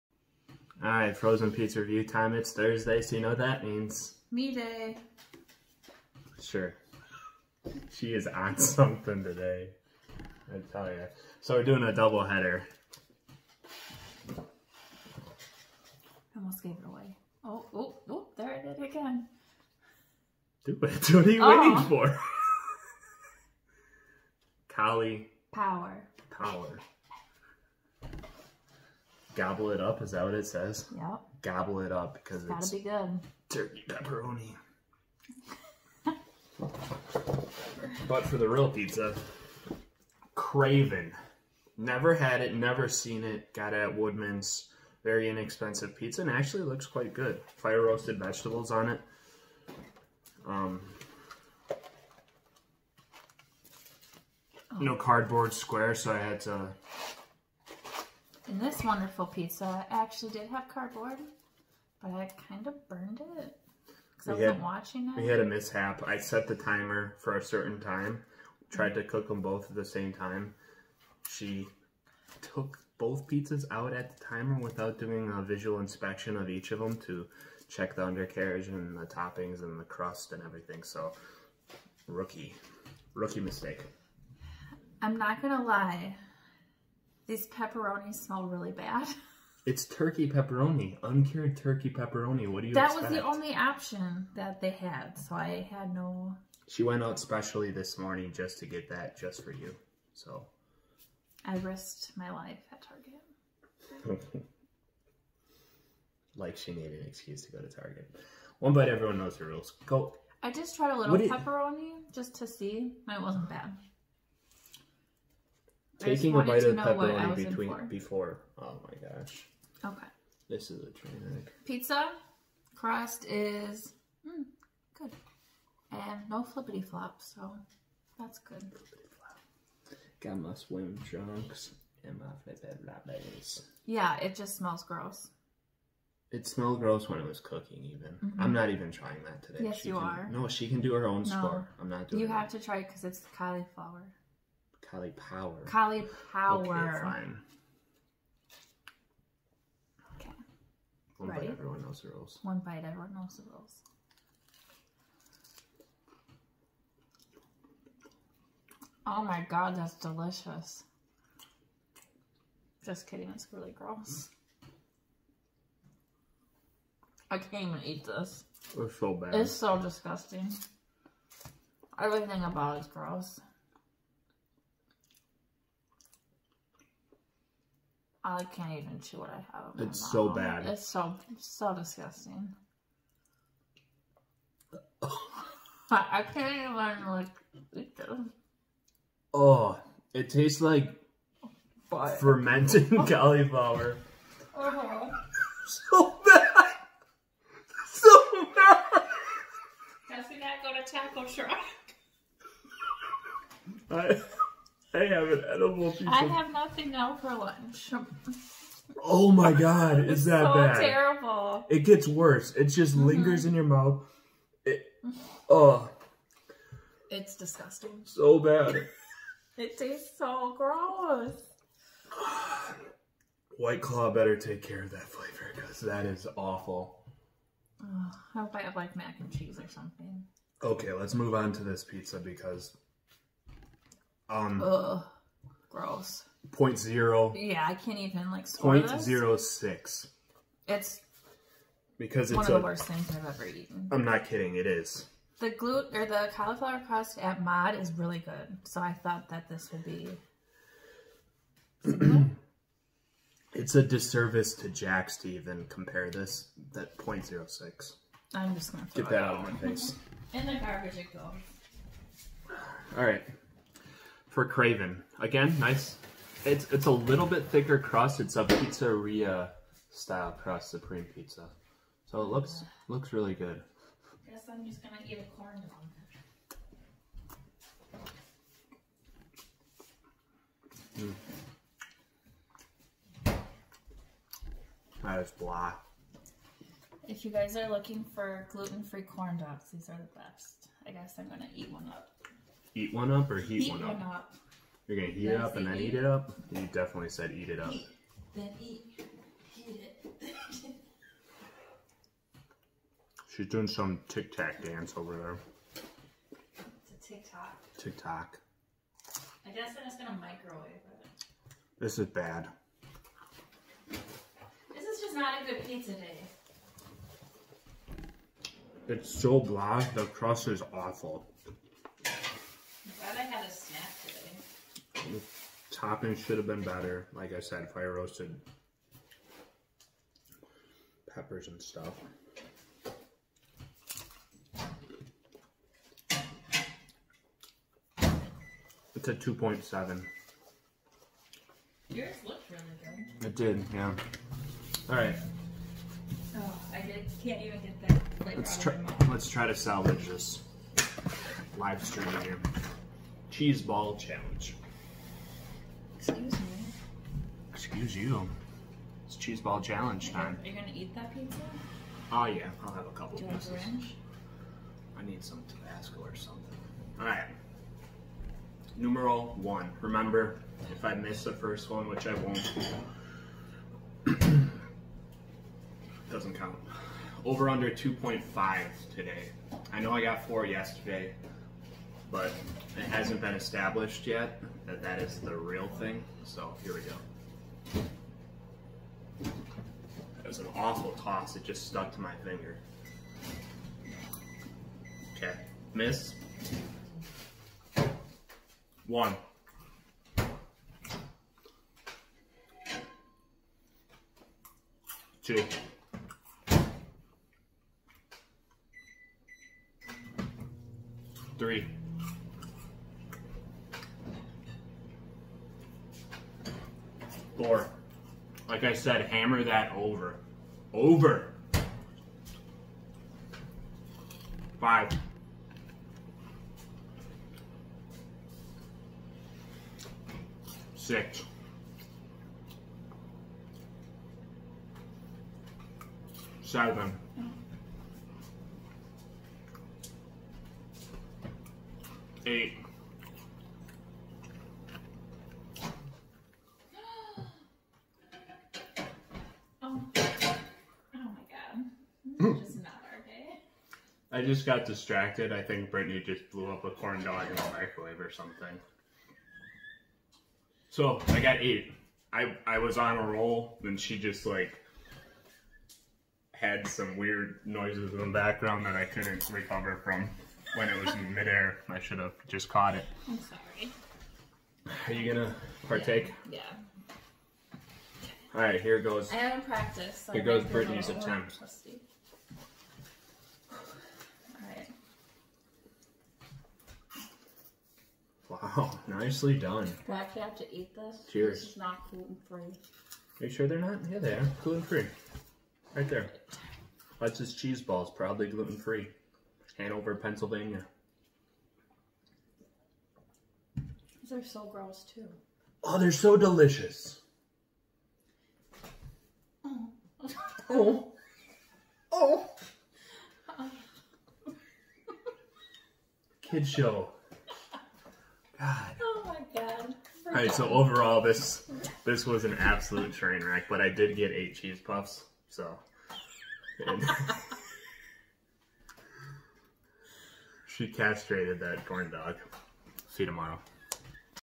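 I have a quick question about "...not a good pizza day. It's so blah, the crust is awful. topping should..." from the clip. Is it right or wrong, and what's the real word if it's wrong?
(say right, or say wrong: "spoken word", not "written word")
right.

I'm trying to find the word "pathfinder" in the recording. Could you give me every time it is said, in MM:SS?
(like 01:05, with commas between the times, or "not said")
not said.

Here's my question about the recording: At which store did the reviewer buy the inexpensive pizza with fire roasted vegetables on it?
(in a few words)
Woodman's.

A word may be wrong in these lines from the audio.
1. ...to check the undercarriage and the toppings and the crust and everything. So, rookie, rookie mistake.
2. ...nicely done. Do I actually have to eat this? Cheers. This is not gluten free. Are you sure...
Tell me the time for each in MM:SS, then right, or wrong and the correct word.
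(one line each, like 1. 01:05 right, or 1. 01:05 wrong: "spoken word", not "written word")
1. 01:16 right
2. 08:08 right.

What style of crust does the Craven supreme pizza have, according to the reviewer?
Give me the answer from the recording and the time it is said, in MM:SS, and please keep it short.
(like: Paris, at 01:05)
Pizzeria style, at 04:28.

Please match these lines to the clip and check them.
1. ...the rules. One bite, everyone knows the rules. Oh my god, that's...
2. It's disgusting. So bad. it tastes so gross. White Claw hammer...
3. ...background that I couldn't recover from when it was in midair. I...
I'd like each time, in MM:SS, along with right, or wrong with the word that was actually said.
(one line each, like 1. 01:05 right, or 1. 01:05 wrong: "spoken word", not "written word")
1. 02:32 right
2. 03:37 wrong: "better", not "hammer"
3. 07:48 right.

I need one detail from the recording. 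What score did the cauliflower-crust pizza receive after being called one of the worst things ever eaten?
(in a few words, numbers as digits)
0.06.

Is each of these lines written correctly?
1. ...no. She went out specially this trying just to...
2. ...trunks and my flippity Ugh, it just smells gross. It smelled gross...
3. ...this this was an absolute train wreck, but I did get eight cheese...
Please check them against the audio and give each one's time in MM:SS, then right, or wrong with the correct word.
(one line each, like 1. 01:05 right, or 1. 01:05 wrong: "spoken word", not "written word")
1. 01:35 wrong: "morning", not "trying"
2. 02:11 wrong: "Yeah", not "Ugh"
3. 08:40 right.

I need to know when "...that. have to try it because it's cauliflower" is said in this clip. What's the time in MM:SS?
02:22.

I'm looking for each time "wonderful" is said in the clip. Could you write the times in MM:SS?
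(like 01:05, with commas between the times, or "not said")
00:58.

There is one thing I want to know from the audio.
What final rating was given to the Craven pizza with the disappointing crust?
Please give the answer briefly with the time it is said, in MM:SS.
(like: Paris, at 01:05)
2.7, at 05:39.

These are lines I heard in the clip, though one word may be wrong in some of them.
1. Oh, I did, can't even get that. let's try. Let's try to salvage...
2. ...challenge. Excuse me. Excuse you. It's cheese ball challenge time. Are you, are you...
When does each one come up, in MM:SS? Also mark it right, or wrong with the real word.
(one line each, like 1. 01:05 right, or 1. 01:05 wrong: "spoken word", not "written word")
1. 05:46 right
2. 05:53 right.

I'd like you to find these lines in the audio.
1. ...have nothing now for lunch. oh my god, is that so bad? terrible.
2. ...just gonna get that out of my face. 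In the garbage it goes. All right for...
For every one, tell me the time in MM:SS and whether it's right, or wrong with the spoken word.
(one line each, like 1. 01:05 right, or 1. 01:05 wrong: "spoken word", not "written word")
1. 03:26 right
2. 04:18 right.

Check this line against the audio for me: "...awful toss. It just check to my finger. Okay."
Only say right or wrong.
wrong.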